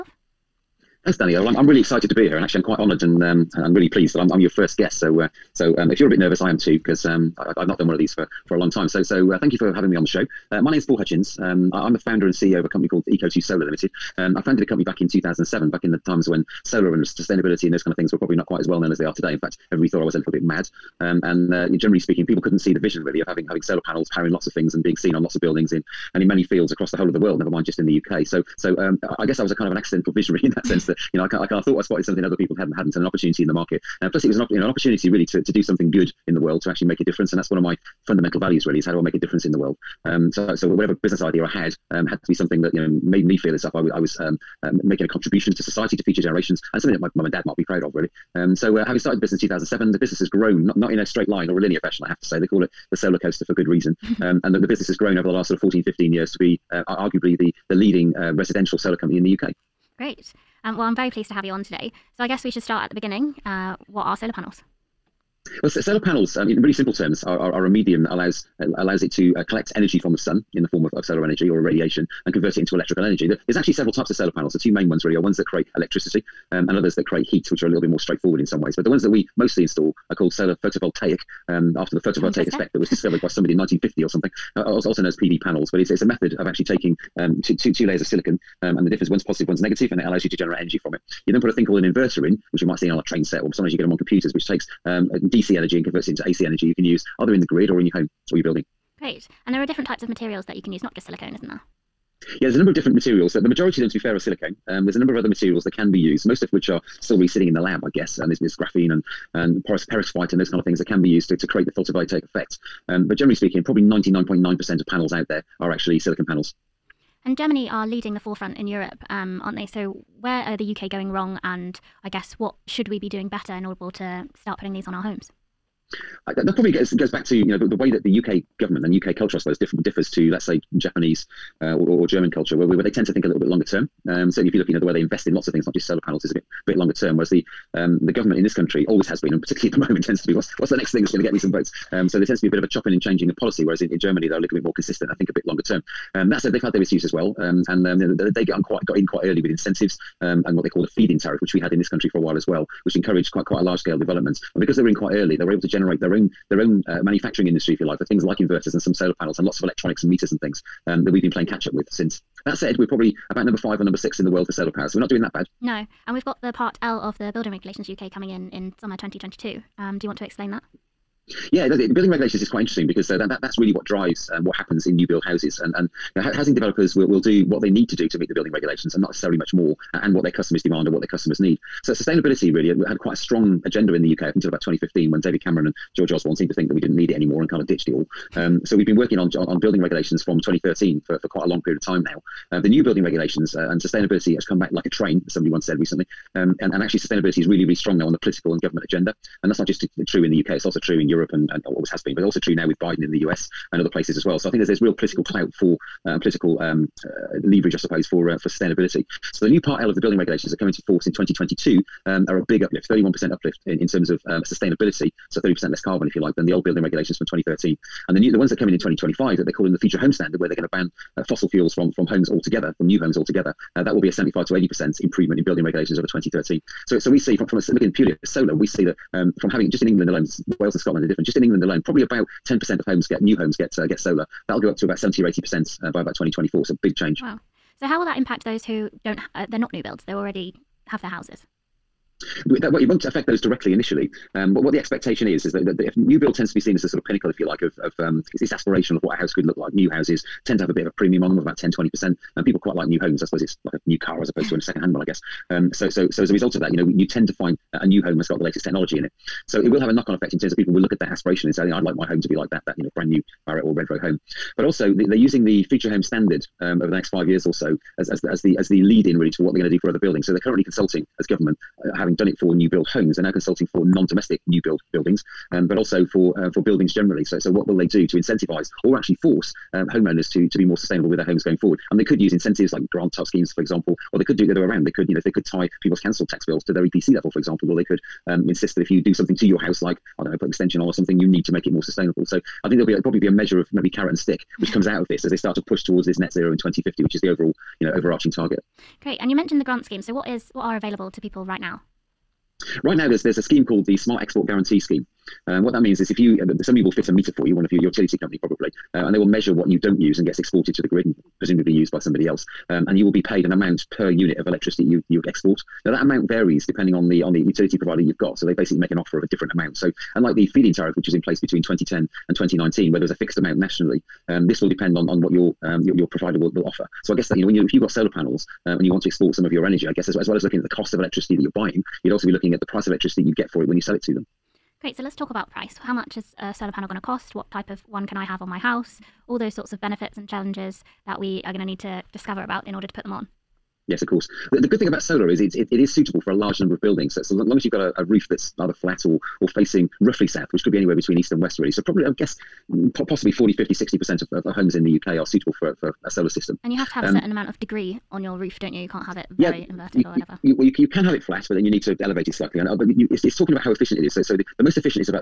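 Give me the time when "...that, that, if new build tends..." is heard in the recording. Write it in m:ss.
4:05.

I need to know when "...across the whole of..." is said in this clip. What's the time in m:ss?
0:26.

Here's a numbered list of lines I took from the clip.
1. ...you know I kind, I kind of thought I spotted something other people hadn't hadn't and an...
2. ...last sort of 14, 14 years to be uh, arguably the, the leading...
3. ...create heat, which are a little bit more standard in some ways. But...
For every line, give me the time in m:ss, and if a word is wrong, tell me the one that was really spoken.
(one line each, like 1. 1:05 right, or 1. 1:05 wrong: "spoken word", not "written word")
1. 0:31 right
2. 0:55 wrong: "15", not "14"
3. 1:17 wrong: "straightforward", not "standard".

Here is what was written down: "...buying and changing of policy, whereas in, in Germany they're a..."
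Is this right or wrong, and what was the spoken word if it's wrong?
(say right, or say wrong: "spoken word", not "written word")
wrong: "chopping", not "buying".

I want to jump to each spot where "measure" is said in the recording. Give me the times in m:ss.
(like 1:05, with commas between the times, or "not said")
4:53, 5:09.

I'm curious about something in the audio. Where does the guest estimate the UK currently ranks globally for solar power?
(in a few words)
number 5 or 6.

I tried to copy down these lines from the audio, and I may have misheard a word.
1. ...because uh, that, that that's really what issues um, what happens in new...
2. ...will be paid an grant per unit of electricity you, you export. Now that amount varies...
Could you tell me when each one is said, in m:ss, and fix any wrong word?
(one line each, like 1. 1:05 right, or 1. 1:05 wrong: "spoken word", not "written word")
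1. 2:52 wrong: "drives", not "issues"
2. 5:13 wrong: "amount", not "grant".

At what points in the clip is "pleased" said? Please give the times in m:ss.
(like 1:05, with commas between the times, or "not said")
0:03, 1:01.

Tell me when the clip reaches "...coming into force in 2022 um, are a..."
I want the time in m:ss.
3:30.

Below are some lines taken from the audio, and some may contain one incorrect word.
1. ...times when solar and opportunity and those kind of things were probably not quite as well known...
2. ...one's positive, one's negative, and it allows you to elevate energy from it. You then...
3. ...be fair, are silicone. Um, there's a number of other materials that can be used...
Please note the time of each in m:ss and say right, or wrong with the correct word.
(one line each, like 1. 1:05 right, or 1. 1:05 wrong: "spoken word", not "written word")
1. 0:16 wrong: "sustainability", not "opportunity"
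2. 1:29 wrong: "generate", not "elevate"
3. 1:43 right.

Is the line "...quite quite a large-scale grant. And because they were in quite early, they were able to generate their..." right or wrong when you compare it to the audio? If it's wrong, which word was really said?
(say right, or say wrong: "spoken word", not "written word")
wrong: "development", not "grant".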